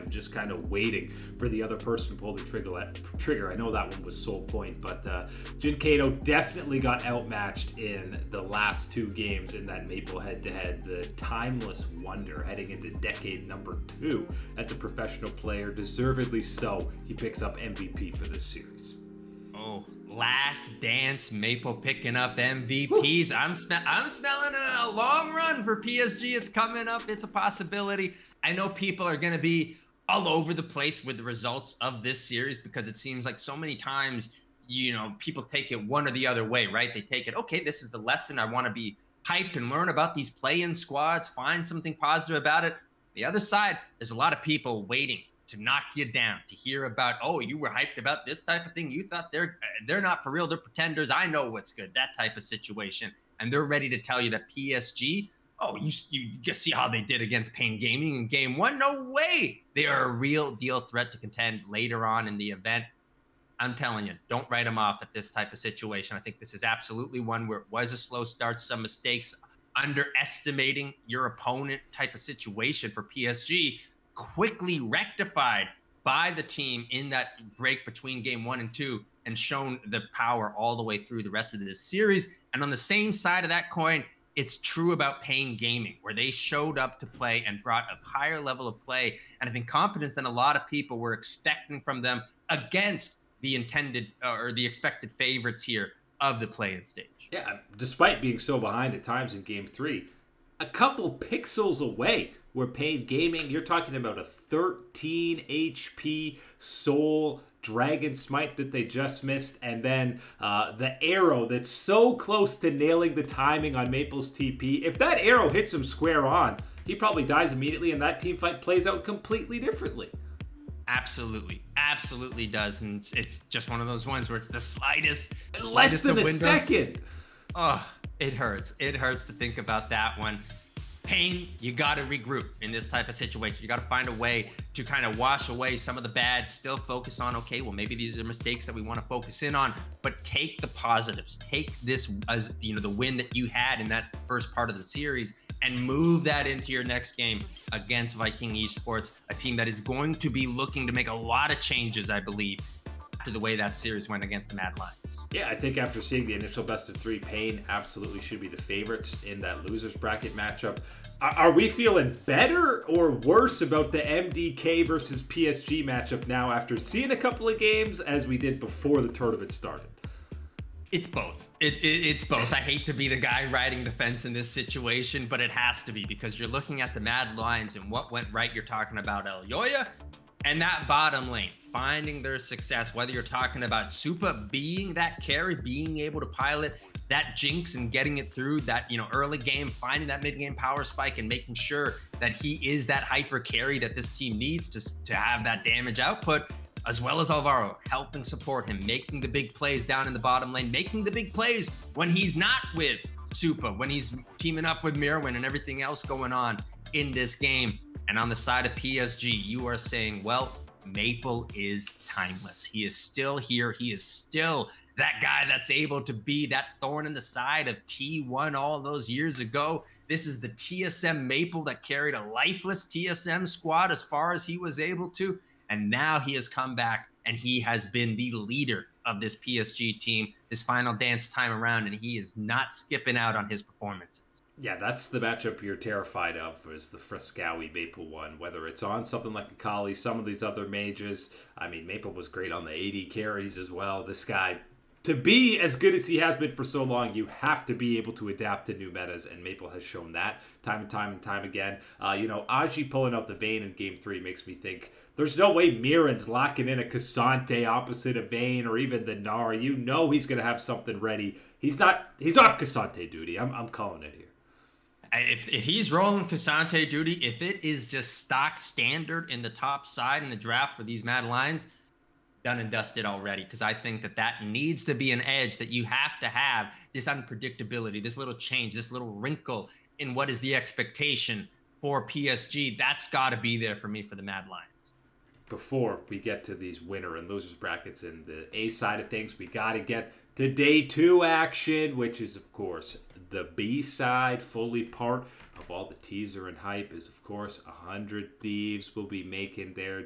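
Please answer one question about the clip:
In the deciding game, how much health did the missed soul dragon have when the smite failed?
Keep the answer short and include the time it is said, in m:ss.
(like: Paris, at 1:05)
13 HP, at 1:44.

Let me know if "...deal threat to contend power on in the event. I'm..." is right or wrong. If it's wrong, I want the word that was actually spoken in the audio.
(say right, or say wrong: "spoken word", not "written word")
wrong: "later", not "power".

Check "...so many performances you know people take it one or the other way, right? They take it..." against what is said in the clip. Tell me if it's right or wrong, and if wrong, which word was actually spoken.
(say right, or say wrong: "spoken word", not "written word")
wrong: "times", not "performances".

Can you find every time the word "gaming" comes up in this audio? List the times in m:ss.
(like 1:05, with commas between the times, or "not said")
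0:57, 1:25, 1:43.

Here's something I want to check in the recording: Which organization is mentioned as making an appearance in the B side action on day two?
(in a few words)
100 Thieves.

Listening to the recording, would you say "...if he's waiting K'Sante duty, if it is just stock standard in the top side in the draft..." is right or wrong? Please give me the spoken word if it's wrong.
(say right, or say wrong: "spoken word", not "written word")
wrong: "rolling", not "waiting".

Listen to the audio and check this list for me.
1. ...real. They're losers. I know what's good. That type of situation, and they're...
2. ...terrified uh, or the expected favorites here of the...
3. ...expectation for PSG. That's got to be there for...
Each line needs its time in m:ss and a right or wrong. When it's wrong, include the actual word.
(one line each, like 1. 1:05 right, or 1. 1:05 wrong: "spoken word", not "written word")
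1. 0:50 wrong: "pretenders", not "losers"
2. 1:33 wrong: "intended", not "terrified"
3. 4:40 right.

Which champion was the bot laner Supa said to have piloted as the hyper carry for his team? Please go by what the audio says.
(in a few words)
Jinx.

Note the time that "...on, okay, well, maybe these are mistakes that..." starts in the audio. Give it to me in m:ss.
2:17.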